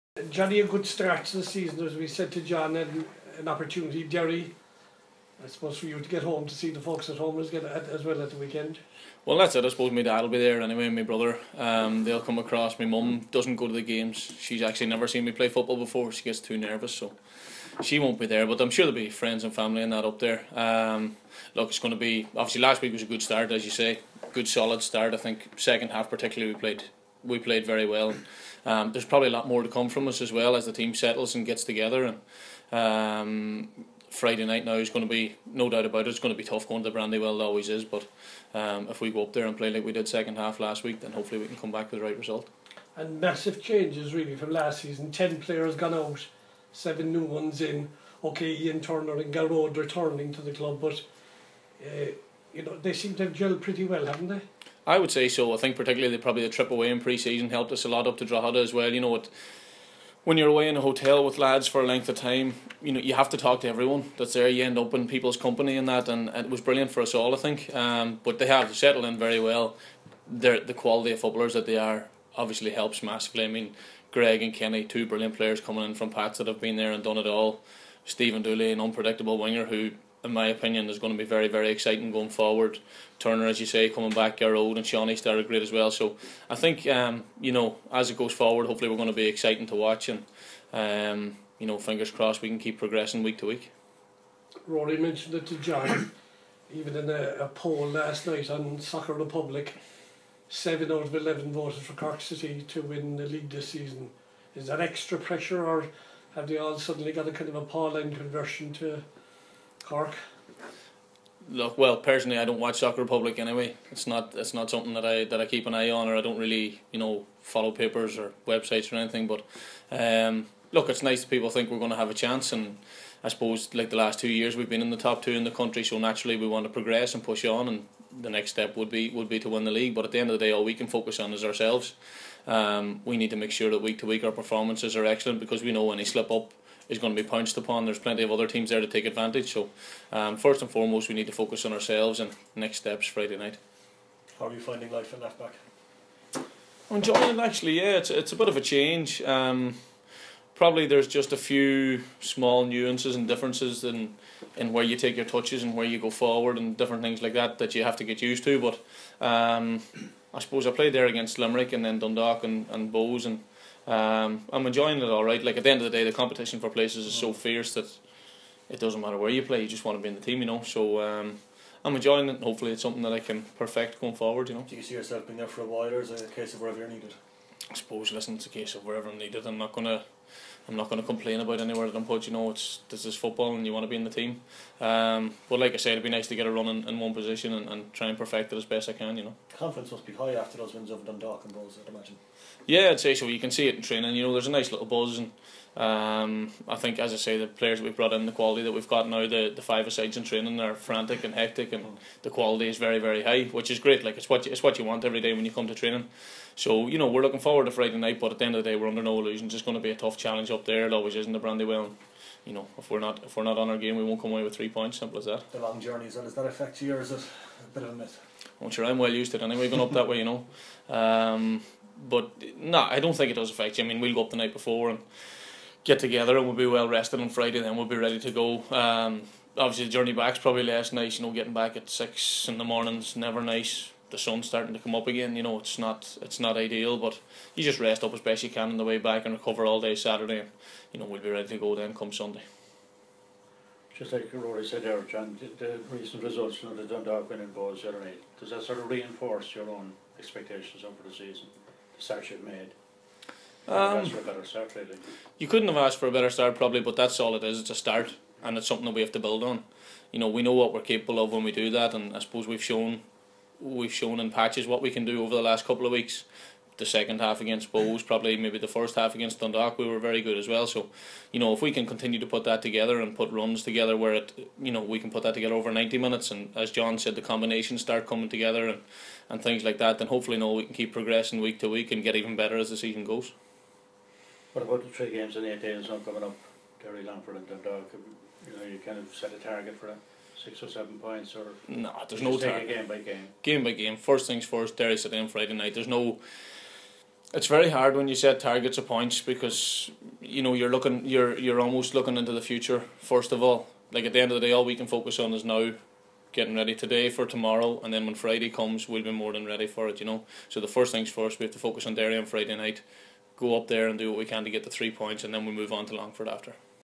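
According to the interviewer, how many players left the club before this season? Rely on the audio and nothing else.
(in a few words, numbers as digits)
10.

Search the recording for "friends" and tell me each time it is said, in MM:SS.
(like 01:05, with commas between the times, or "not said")
00:19.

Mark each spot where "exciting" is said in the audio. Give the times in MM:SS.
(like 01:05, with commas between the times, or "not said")
01:21, 01:29.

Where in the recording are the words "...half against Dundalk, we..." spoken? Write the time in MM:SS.
04:28.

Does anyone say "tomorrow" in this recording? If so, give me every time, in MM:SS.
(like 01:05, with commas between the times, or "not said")
05:07.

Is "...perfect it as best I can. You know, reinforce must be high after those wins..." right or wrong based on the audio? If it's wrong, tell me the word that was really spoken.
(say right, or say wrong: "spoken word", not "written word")
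wrong: "confidence", not "reinforce".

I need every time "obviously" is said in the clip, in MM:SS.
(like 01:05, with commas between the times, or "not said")
00:22, 01:12, 03:49.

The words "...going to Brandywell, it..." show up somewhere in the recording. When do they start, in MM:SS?
00:36.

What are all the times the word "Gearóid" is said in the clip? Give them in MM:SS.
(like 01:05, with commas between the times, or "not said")
00:49, 01:24.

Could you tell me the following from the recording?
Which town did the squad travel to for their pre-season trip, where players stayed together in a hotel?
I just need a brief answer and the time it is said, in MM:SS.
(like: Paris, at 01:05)
Drogheda, at 00:58.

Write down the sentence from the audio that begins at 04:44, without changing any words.
What about the three games in eight days coming up, Derry, Longford, and Dundalk?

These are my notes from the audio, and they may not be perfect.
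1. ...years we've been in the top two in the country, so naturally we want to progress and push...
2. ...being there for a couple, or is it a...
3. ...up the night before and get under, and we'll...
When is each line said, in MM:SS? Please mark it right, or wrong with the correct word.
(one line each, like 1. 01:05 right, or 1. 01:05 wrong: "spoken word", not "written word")
1. 02:04 right
2. 02:55 wrong: "while", not "couple"
3. 03:44 wrong: "together", not "under".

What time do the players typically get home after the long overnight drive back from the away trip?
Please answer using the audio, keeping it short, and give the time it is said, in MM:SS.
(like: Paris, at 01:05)
6 in the morning, at 03:51.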